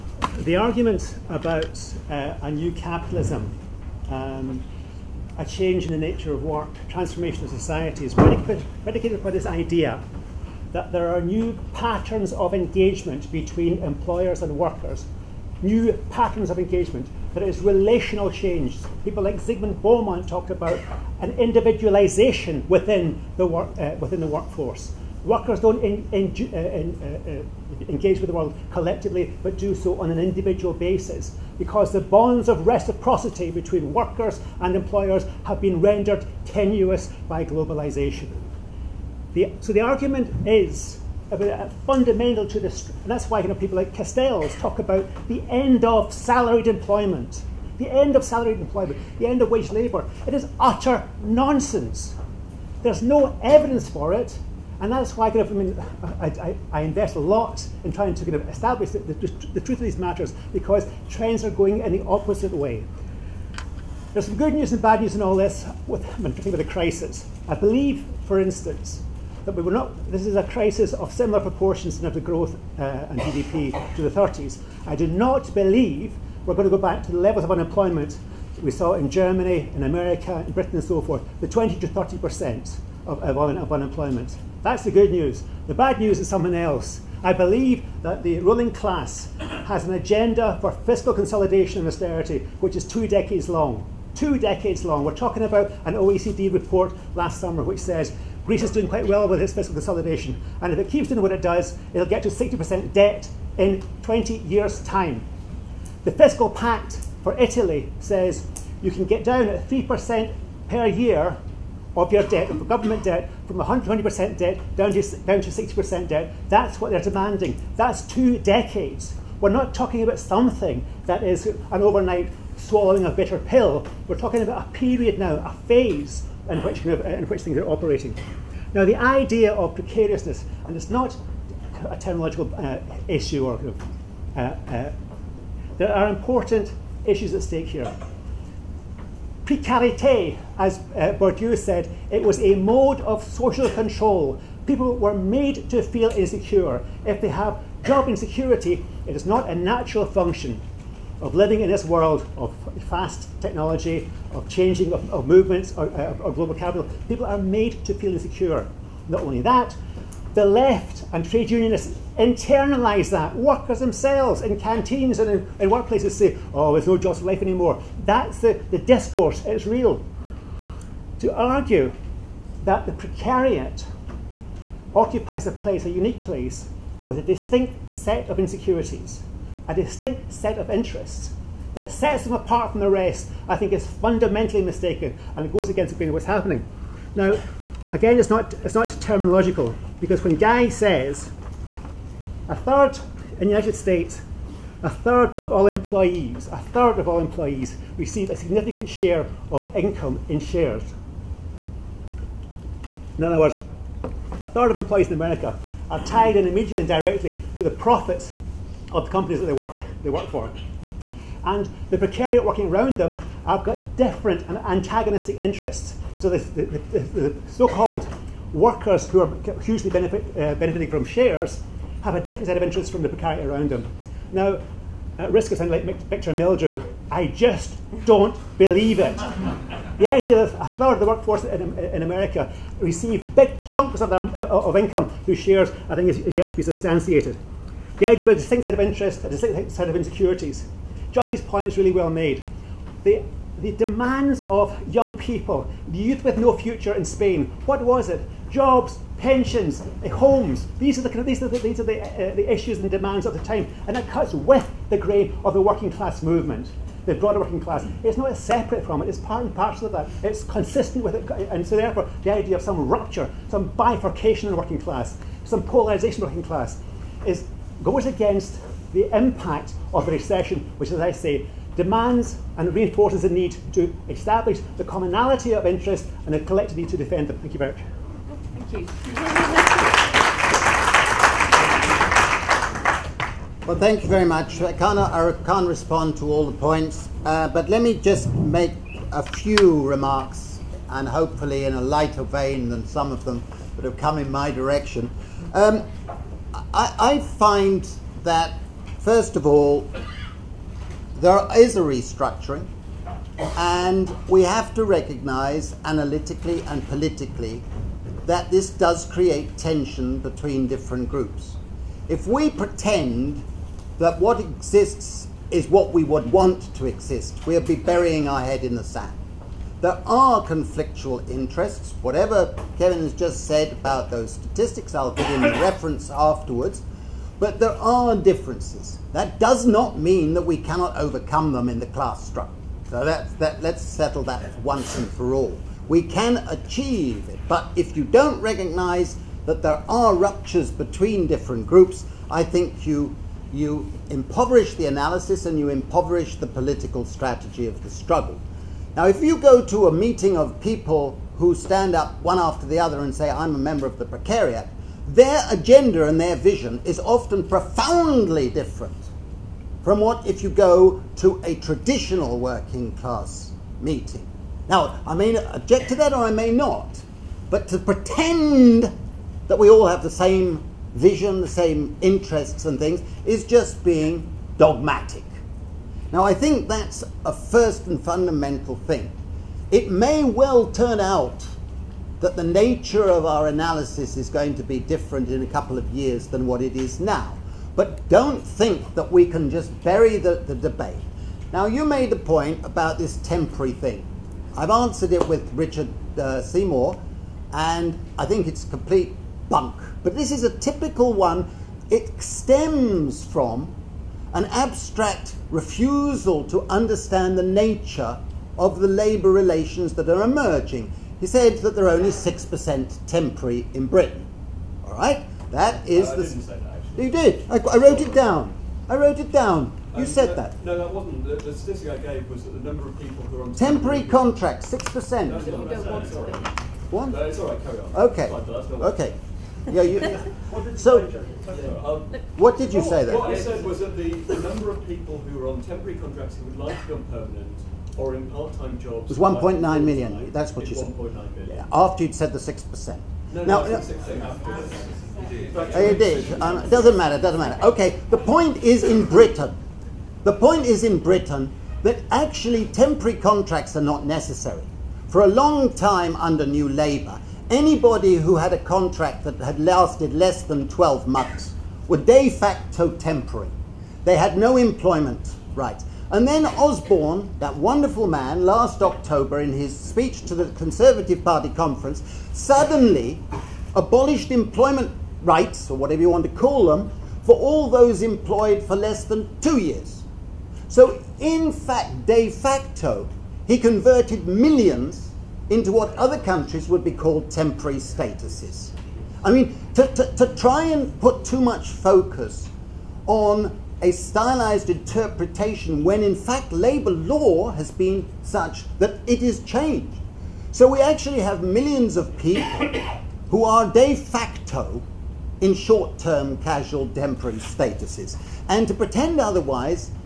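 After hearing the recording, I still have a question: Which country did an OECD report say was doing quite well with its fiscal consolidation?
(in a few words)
Greece.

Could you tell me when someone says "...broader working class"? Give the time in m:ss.
4:17.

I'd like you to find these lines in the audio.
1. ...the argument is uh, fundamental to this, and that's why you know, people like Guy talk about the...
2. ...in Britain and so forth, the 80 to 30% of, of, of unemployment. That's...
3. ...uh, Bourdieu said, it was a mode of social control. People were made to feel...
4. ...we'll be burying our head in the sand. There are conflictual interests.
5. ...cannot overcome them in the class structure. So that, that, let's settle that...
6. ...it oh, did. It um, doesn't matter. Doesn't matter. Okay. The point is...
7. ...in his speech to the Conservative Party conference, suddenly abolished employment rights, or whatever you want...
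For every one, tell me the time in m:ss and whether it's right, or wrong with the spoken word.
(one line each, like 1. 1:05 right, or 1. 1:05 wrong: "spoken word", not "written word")
1. 0:39 wrong: "Castells", not "Guy"
2. 1:20 wrong: "20", not "80"
3. 2:20 right
4. 5:17 right
5. 5:30 right
6. 7:25 right
7. 7:49 right.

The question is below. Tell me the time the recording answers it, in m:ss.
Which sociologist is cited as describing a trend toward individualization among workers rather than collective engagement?
0:19.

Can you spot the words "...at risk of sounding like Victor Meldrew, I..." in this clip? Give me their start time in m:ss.
3:45.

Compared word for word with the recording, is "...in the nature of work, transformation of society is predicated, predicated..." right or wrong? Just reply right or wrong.
right.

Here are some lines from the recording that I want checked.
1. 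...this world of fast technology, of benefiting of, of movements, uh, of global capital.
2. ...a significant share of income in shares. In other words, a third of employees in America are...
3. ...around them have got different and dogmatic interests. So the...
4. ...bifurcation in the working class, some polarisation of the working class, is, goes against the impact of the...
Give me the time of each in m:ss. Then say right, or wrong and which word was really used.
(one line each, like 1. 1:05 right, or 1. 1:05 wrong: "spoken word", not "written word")
1. 2:31 wrong: "changing", not "benefiting"
2. 3:18 right
3. 3:32 wrong: "antagonistic", not "dogmatic"
4. 4:23 right.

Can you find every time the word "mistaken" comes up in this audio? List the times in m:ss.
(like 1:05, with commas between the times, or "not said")
3:04.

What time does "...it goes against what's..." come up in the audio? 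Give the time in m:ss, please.
3:05.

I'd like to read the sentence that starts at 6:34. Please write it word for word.
I've answered it with Richard uh, Seymour, and I think it's complete bunk.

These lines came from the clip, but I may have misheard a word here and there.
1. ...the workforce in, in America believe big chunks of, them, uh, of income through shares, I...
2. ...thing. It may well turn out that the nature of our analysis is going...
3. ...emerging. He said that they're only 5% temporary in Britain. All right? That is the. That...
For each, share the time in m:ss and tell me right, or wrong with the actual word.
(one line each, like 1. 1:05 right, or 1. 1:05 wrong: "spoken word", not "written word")
1. 3:51 wrong: "receive", not "believe"
2. 6:18 right
3. 6:50 wrong: "6", not "5".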